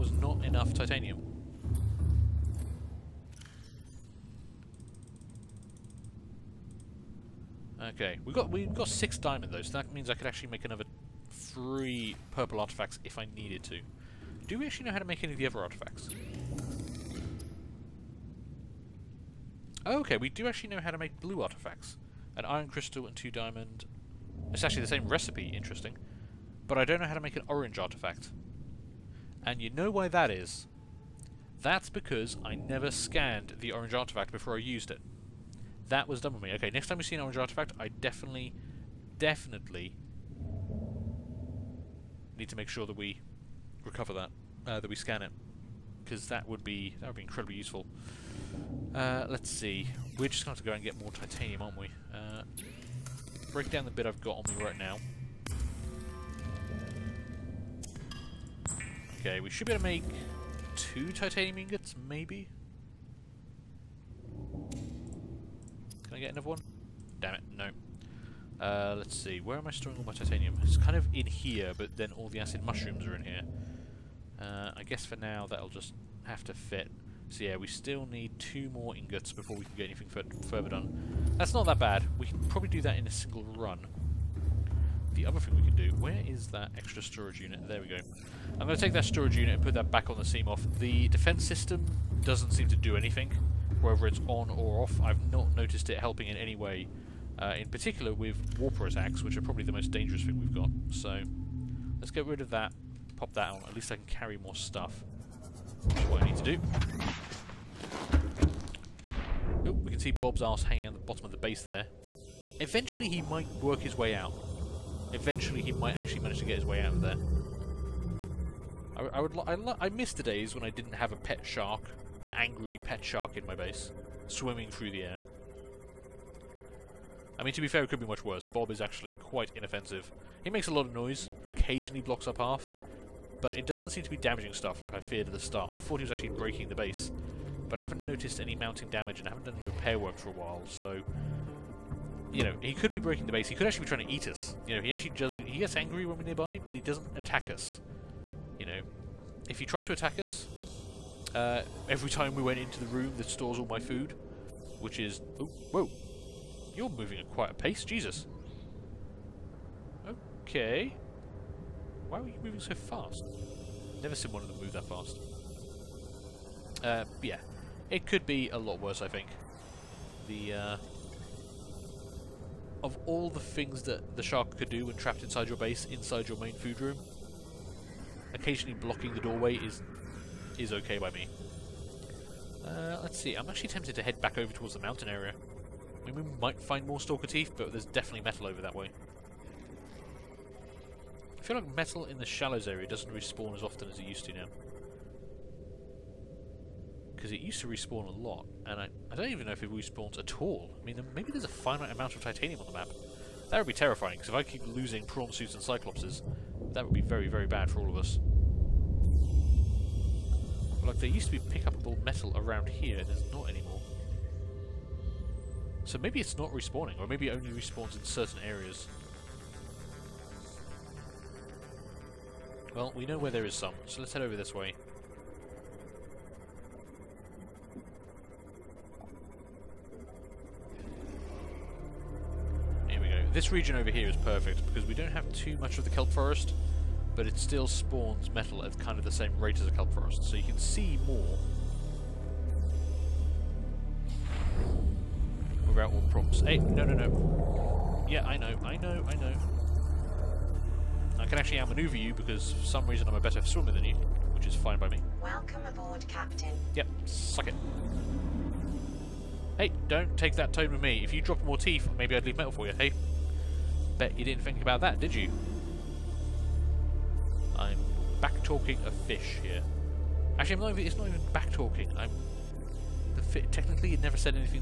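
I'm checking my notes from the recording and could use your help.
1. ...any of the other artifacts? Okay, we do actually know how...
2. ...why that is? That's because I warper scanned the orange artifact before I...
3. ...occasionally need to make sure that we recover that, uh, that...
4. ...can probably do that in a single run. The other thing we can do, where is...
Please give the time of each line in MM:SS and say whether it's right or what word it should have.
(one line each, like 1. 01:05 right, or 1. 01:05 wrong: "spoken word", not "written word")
1. 00:15 right
2. 00:29 wrong: "never", not "warper"
3. 00:39 wrong: "definitely", not "occasionally"
4. 01:22 right.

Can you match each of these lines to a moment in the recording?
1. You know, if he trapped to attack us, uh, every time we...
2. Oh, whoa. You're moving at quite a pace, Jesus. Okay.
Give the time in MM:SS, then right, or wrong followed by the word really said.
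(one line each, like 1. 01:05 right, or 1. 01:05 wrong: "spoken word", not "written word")
1. 02:28 wrong: "tried", not "trapped"
2. 02:35 right.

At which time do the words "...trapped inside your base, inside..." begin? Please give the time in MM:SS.
02:54.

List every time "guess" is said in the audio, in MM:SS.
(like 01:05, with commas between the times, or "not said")
01:14.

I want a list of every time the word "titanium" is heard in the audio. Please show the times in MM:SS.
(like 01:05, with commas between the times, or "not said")
00:00, 00:51, 01:01, 01:10, 03:22.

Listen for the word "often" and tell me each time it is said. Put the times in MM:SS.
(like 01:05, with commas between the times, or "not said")
03:13.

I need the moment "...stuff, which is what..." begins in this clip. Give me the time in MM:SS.
01:44.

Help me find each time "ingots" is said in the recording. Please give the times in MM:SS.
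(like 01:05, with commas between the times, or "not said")
01:01, 01:18.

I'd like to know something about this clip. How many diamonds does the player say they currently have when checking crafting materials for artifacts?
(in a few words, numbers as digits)
6.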